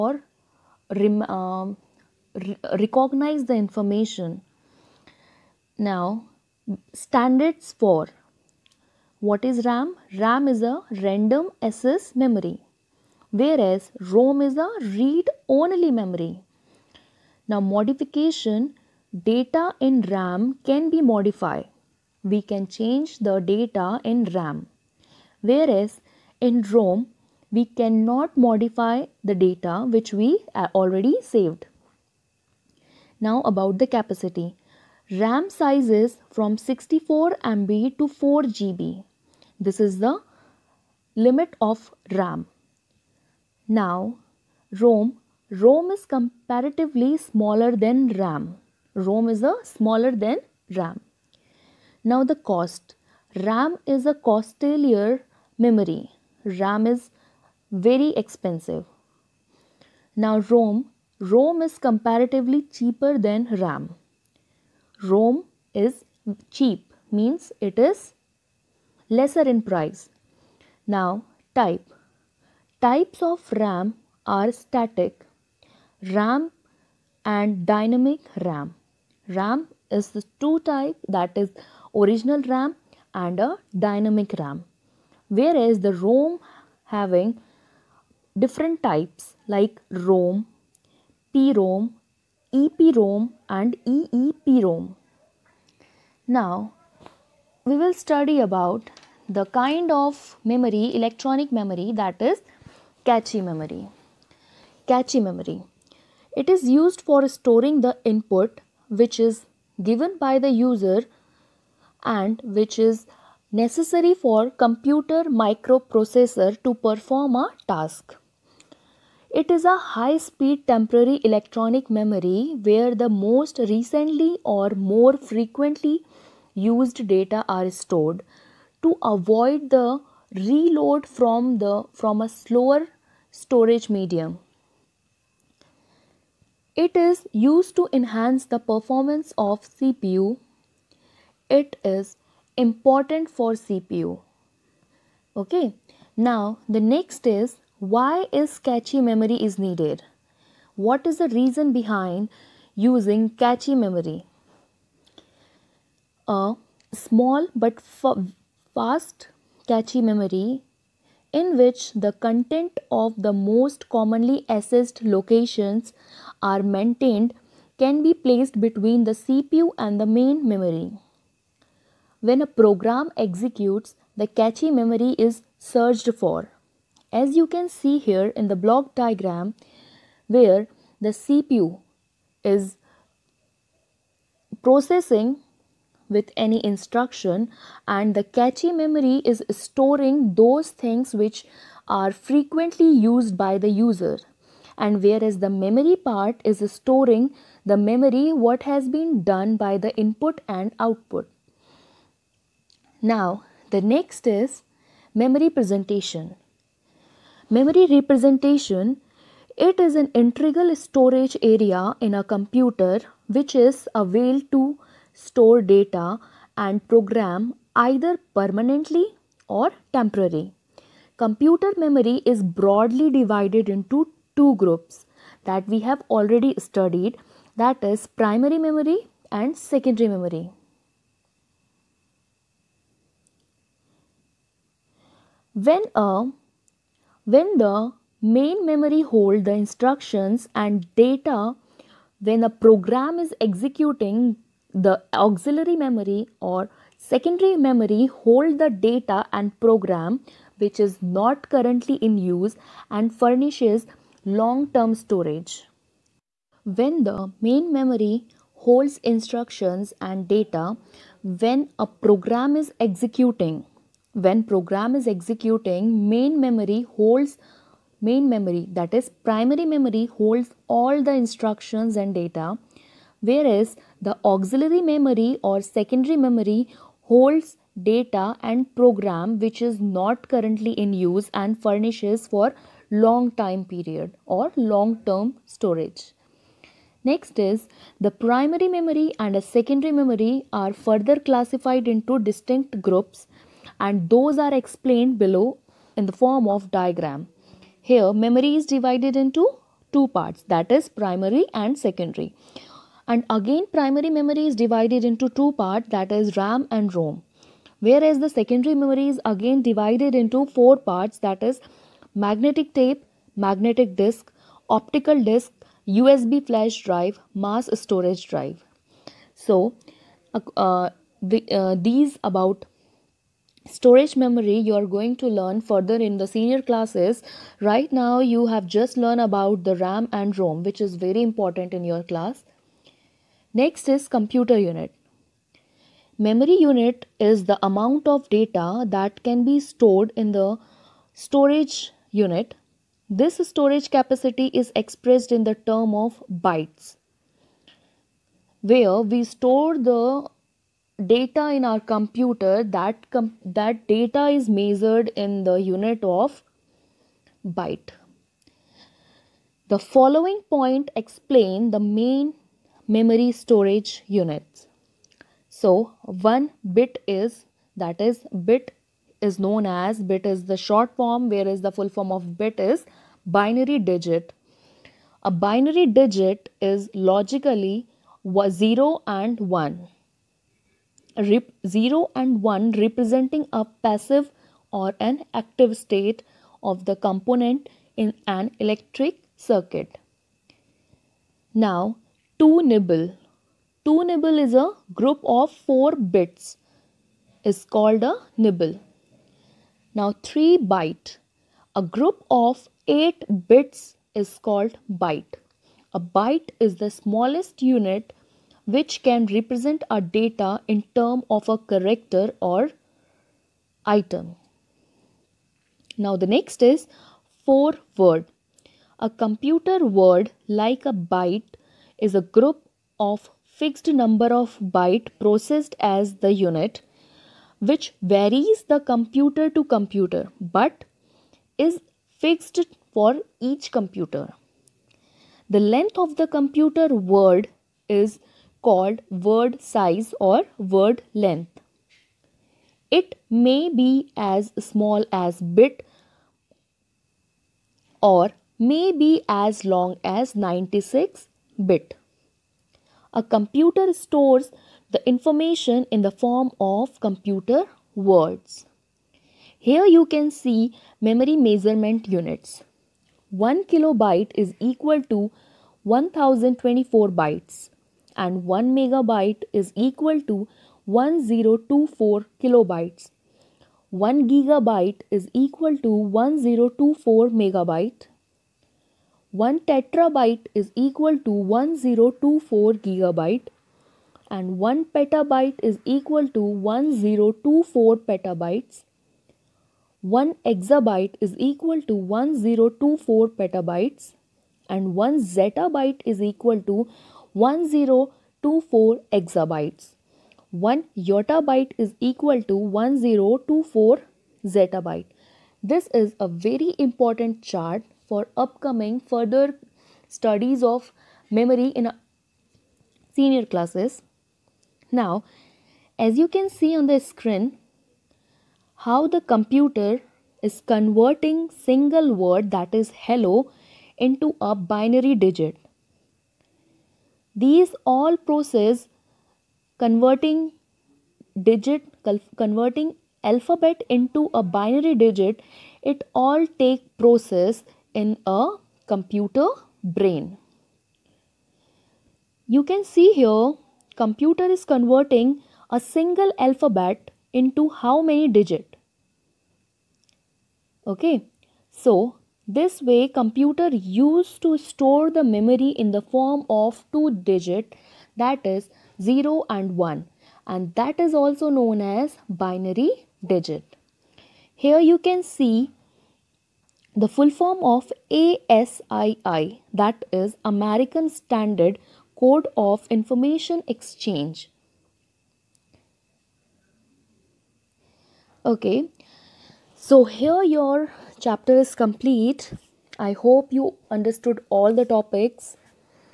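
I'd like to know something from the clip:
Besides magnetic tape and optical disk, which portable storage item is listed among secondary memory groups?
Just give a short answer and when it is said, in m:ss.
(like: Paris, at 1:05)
USB flash drive, at 5:15.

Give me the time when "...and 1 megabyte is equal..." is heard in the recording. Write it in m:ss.
7:48.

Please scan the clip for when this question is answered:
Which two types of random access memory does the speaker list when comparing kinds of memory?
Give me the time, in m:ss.
1:14.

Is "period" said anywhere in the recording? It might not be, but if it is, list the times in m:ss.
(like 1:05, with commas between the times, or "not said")
4:43.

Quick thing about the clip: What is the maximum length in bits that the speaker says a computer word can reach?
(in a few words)
96 bit.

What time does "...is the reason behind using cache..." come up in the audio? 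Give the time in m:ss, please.
2:31.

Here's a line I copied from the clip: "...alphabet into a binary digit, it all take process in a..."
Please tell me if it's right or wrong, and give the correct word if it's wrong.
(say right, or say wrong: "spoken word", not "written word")
right.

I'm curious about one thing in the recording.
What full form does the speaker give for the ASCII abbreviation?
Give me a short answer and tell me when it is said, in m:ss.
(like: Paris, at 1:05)
American Standard Code of Information Exchange, at 9:30.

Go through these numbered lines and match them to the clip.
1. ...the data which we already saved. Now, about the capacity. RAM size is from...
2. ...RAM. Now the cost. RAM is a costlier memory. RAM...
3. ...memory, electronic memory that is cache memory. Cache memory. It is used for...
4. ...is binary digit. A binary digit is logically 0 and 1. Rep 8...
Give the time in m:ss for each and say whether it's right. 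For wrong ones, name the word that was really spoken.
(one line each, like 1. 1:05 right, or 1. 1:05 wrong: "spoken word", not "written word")
1. 0:29 right
2. 0:50 right
3. 1:40 right
4. 6:12 wrong: "0", not "8".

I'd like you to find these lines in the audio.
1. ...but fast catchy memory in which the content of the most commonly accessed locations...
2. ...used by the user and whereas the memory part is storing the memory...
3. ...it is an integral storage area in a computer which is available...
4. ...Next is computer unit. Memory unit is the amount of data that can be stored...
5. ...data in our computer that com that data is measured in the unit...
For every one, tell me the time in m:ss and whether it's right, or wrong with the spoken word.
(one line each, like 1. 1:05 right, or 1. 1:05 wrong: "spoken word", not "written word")
1. 2:37 right
2. 3:12 right
3. 3:29 right
4. 5:33 right
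5. 5:51 right.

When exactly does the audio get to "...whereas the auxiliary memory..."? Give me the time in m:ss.
4:33.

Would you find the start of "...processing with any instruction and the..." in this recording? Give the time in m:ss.
3:04.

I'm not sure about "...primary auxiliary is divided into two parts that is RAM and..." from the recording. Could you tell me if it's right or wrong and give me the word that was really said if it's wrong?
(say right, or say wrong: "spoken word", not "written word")
wrong: "memory", not "auxiliary".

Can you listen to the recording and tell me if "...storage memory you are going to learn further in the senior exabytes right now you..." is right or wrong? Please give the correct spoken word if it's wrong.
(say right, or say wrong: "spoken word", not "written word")
wrong: "classes", not "exabytes".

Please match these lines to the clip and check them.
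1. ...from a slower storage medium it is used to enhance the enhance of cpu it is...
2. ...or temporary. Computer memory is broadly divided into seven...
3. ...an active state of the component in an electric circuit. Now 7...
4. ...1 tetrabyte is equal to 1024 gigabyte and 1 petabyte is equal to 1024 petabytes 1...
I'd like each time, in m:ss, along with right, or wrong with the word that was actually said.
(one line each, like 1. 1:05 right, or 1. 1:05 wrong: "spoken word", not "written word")
1. 2:12 wrong: "performance", not "enhance"
2. 3:39 wrong: "two", not "seven"
3. 6:24 wrong: "2", not "7"
4. 7:59 right.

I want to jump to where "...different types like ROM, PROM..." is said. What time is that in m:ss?
1:28.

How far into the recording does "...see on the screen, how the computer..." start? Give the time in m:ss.
8:36.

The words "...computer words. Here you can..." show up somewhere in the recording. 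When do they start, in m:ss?
7:36.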